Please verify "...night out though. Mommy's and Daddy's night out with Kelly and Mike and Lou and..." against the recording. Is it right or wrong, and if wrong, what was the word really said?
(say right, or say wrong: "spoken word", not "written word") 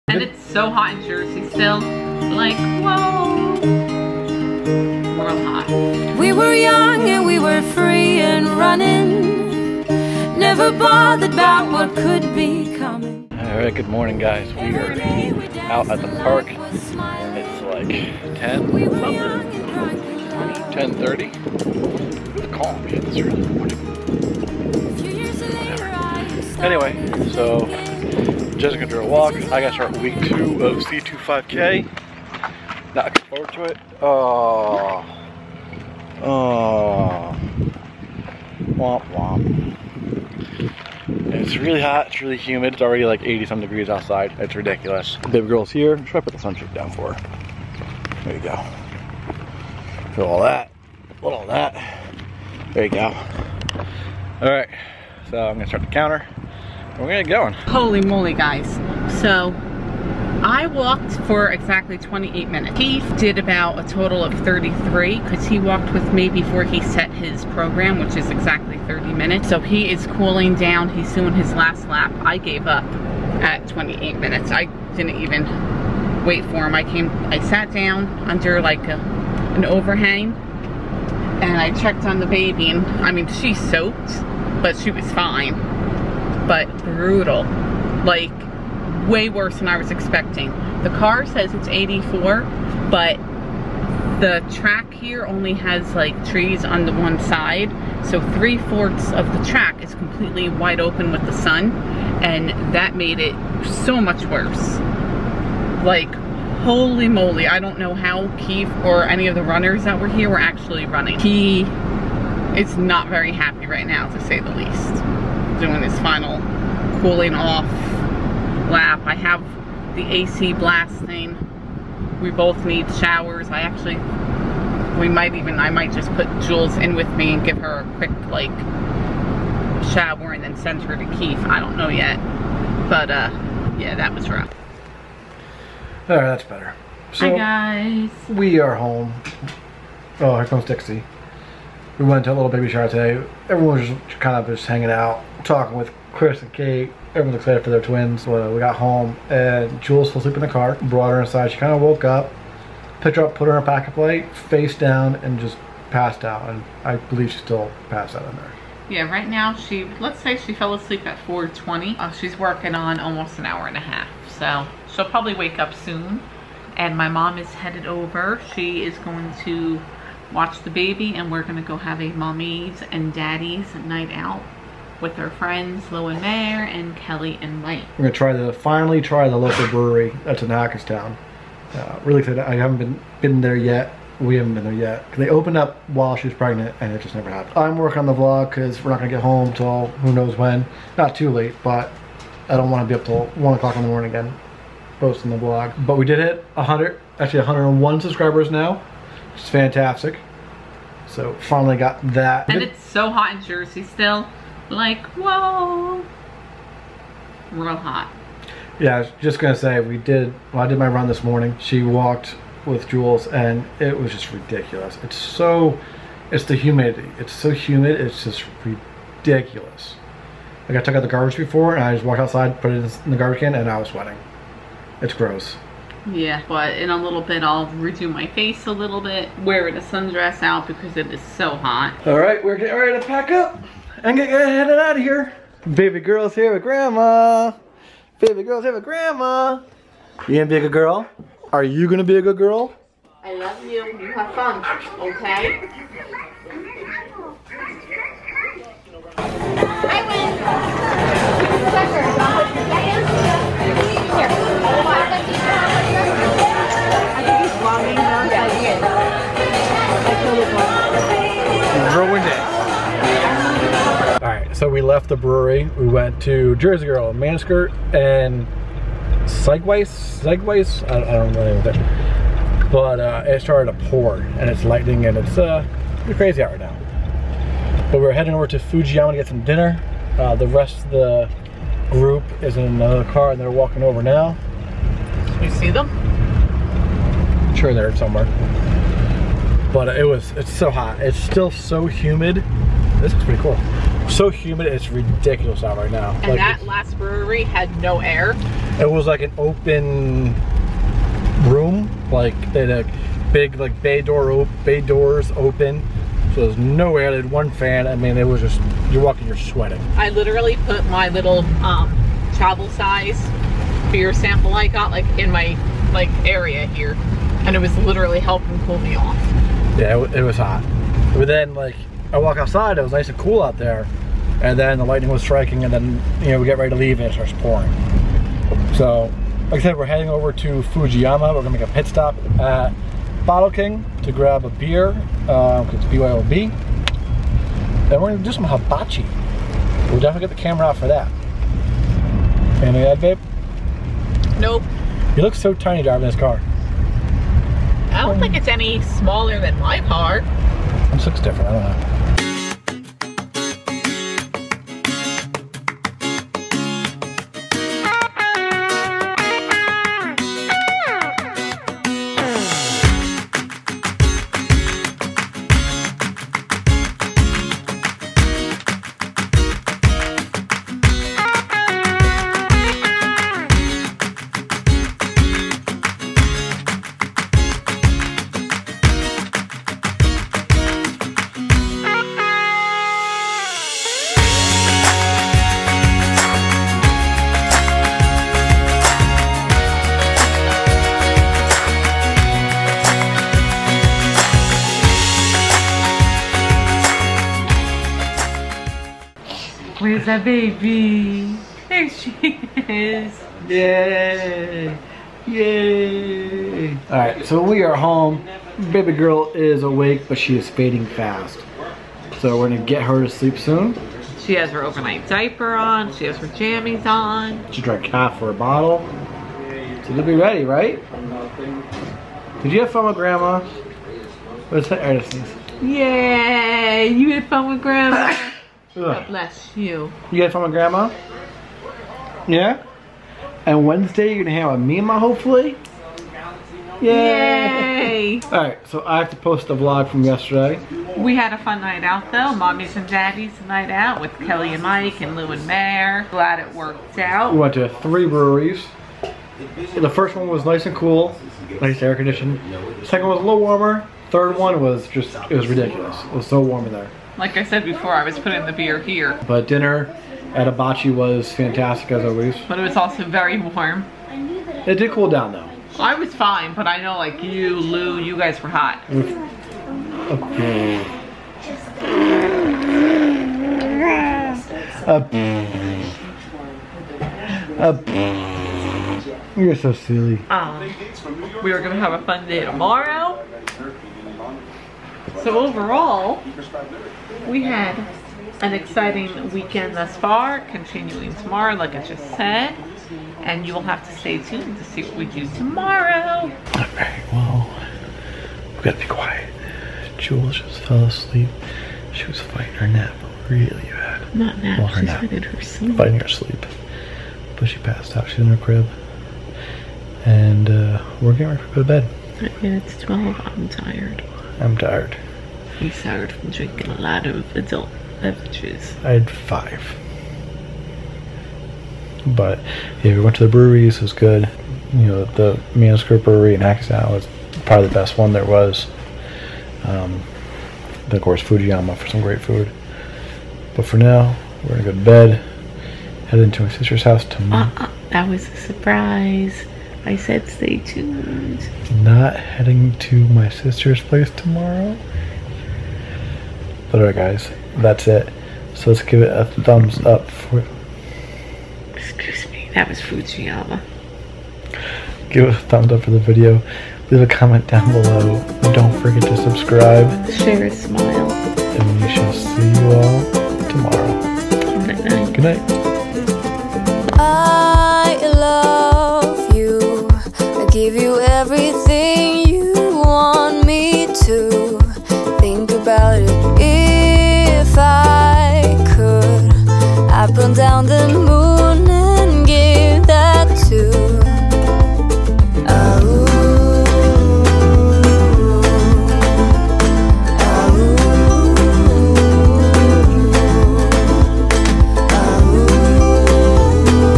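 right.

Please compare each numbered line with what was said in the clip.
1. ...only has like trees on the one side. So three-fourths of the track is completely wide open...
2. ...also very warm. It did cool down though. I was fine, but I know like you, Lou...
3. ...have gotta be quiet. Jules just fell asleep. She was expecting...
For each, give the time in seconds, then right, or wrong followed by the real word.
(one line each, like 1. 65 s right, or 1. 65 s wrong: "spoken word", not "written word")
1. 95 s right
2. 462 s right
3. 498 s wrong: "fighting", not "expecting".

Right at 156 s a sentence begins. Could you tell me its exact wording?
And I believe she's still passed out in there.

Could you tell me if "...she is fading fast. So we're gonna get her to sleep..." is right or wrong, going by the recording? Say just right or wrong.
right.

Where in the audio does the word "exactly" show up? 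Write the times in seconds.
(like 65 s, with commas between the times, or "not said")
61 s, 68 s.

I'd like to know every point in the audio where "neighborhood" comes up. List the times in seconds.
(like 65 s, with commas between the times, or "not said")
not said.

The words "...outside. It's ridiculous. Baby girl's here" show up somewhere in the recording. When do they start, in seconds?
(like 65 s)
43 s.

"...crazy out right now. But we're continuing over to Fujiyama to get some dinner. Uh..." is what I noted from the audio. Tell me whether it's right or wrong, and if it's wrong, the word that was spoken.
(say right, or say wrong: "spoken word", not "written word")
wrong: "heading", not "continuing".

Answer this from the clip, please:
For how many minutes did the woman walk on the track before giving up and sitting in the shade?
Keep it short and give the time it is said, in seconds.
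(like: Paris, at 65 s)
28, at 61 s.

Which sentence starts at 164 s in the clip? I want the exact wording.
So she'll probably wake up soon.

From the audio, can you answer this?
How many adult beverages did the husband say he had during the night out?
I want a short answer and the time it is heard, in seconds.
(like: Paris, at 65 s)
5, at 518 s.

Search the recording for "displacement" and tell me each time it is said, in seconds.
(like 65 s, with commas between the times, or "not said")
not said.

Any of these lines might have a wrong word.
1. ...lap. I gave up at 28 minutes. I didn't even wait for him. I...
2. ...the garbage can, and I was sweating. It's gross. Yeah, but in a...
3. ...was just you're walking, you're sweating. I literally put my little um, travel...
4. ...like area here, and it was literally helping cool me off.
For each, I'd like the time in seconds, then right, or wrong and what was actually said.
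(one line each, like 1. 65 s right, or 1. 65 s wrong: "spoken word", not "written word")
1. 71 s right
2. 223 s right
3. 308 s right
4. 315 s right.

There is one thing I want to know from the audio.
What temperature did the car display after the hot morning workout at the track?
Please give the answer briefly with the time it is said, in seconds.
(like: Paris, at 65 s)
84, at 91 s.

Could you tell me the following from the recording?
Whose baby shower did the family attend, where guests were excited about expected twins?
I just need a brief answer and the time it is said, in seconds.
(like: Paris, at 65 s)
Chris and Kate, at 146 s.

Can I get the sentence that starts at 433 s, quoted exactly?
And Wednesday you're gonna have a mima hopefully?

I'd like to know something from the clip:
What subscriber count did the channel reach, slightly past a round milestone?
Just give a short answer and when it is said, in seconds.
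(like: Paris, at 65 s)
101, at 197 s.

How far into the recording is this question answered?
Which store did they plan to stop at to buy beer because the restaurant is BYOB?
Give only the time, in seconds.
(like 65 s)
333 s.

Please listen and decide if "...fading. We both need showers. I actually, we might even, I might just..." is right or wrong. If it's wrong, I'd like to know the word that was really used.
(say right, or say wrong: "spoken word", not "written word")
wrong: "blasting", not "fading".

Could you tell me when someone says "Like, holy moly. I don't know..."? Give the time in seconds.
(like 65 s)
105 s.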